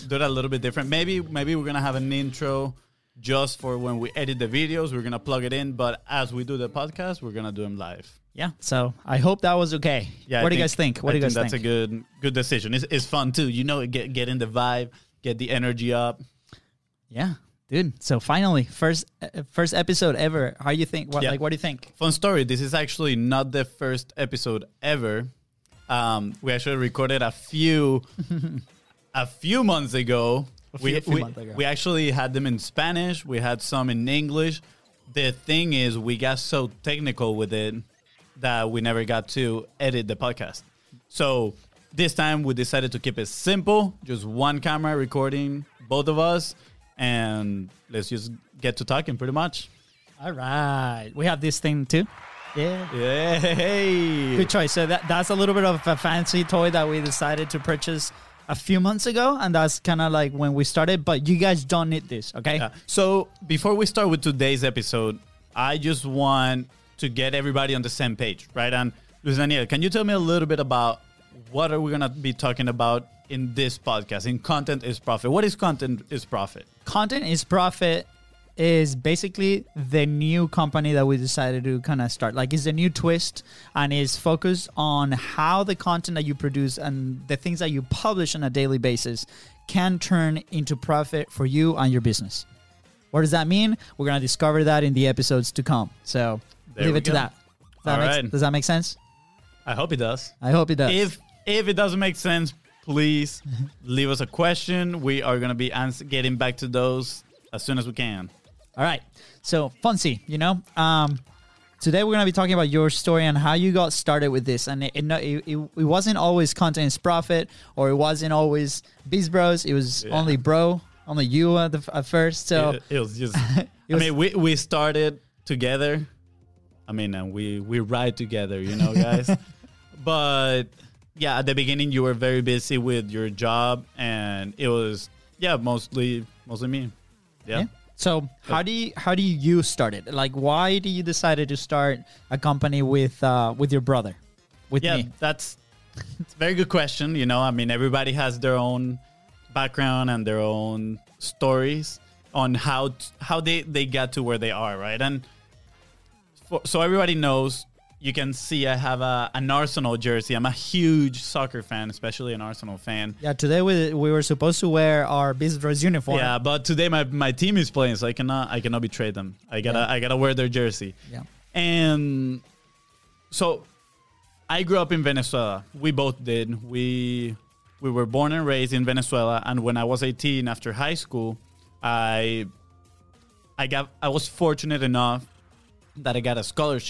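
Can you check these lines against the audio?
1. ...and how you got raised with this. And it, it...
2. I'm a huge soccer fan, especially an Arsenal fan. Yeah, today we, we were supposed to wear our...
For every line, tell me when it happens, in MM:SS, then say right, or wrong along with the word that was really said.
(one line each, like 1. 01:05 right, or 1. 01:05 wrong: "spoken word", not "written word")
1. 01:53 wrong: "started", not "raised"
2. 02:40 right.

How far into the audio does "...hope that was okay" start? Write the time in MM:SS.
00:09.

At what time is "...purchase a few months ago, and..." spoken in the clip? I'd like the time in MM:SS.
00:57.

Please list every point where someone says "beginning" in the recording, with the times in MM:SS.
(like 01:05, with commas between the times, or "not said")
02:11.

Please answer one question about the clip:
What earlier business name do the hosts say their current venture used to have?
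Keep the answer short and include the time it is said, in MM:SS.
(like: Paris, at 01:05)
Biz Bros, at 01:59.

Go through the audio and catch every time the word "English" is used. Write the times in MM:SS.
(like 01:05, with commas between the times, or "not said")
00:34.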